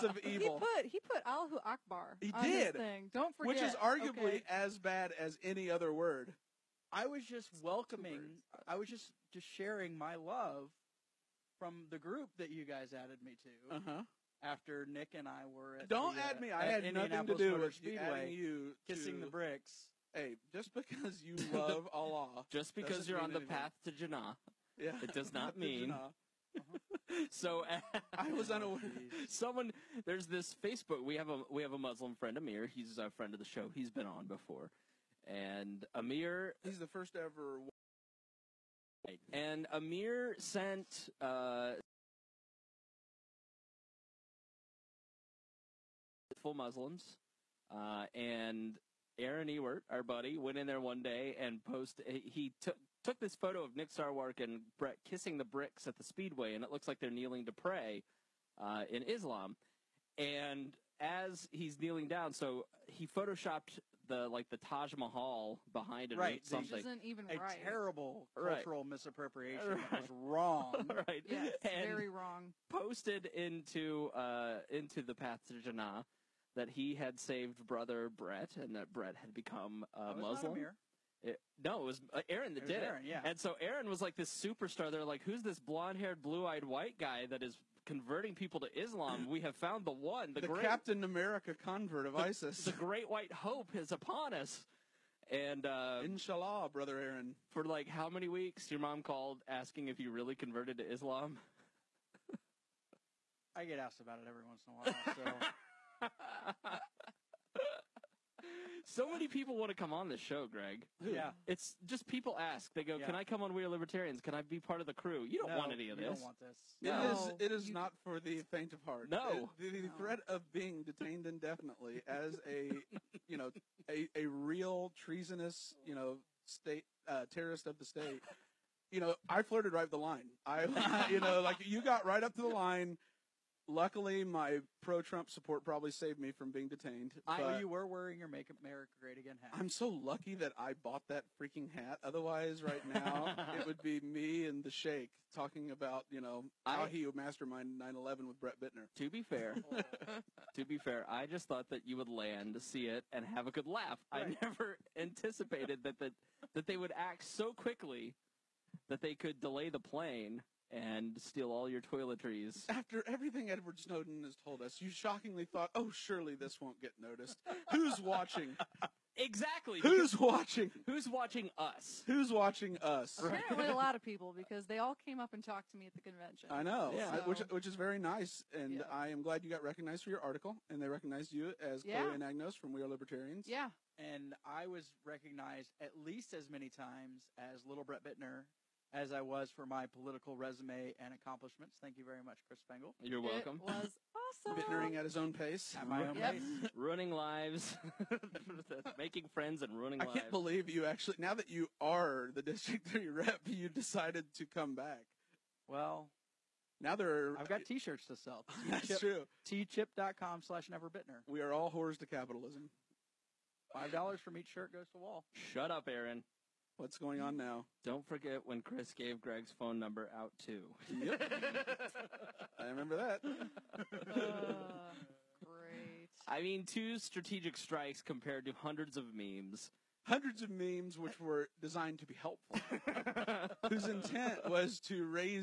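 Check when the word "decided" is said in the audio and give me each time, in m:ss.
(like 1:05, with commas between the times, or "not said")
3:23.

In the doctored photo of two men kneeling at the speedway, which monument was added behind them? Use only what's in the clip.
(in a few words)
Taj Mahal.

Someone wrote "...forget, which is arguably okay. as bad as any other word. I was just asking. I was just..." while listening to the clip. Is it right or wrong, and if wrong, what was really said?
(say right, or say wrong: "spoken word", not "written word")
wrong: "welcoming", not "asking".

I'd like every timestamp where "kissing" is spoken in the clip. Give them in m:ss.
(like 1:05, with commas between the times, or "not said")
0:18, 0:55.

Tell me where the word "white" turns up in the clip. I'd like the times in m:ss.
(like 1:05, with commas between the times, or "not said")
1:26, 1:33.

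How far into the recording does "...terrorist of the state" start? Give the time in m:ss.
2:07.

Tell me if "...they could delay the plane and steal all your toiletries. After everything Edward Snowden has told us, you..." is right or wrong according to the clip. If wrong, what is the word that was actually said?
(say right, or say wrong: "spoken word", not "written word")
right.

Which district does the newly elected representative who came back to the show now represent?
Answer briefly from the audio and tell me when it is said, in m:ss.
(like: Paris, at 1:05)
District 3, at 3:22.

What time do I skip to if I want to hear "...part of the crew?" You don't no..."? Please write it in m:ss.
1:54.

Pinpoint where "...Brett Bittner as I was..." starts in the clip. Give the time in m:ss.
3:07.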